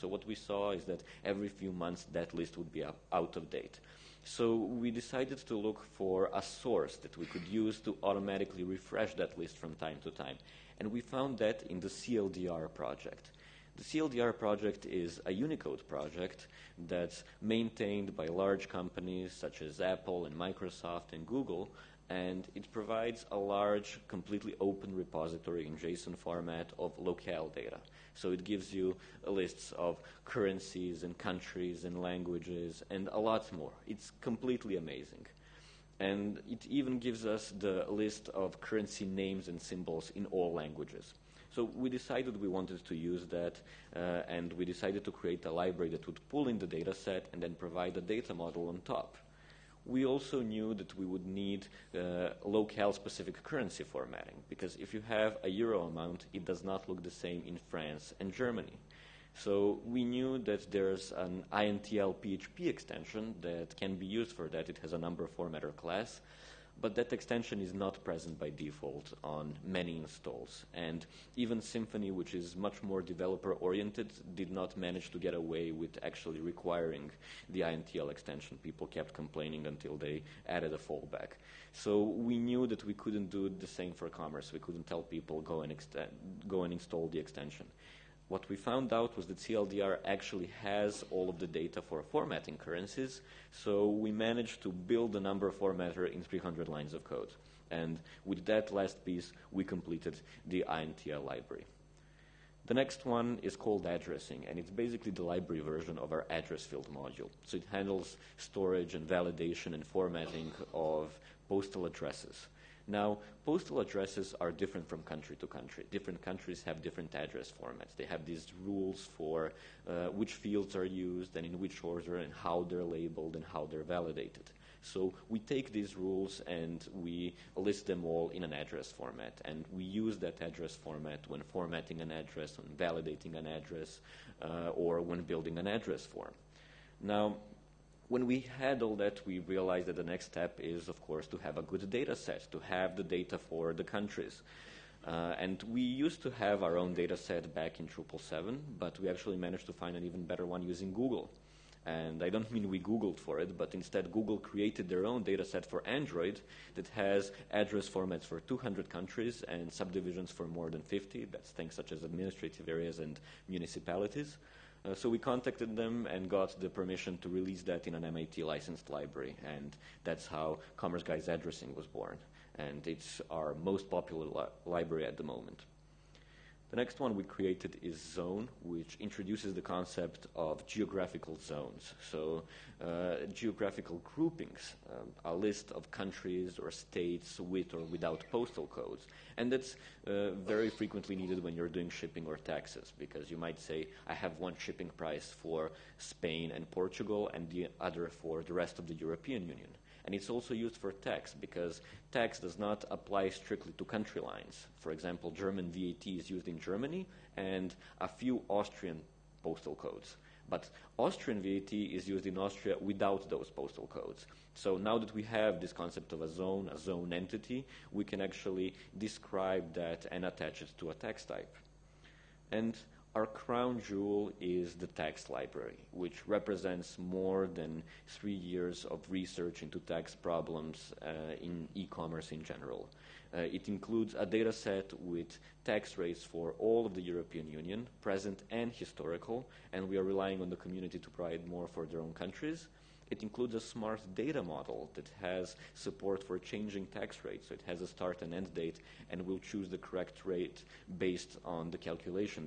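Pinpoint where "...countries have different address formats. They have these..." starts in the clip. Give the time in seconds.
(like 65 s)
116 s.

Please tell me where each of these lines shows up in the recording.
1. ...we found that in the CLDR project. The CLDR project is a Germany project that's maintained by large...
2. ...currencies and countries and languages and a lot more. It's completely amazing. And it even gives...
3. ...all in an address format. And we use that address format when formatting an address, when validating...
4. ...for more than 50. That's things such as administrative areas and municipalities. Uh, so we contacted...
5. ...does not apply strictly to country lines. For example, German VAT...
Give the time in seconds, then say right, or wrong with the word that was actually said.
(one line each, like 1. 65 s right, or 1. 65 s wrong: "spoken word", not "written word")
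1. 10 s wrong: "Unicode", not "Germany"
2. 30 s right
3. 128 s right
4. 160 s right
5. 202 s right.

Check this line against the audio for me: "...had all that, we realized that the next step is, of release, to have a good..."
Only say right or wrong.
wrong.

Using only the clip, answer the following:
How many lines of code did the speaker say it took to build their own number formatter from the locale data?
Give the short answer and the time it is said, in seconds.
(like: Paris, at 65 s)
300, at 96 s.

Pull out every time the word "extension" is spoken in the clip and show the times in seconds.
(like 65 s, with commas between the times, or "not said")
62 s, 67 s, 78 s, 87 s.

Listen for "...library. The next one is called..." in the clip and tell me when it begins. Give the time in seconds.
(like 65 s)
101 s.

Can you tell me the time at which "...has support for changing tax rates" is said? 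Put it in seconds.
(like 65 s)
245 s.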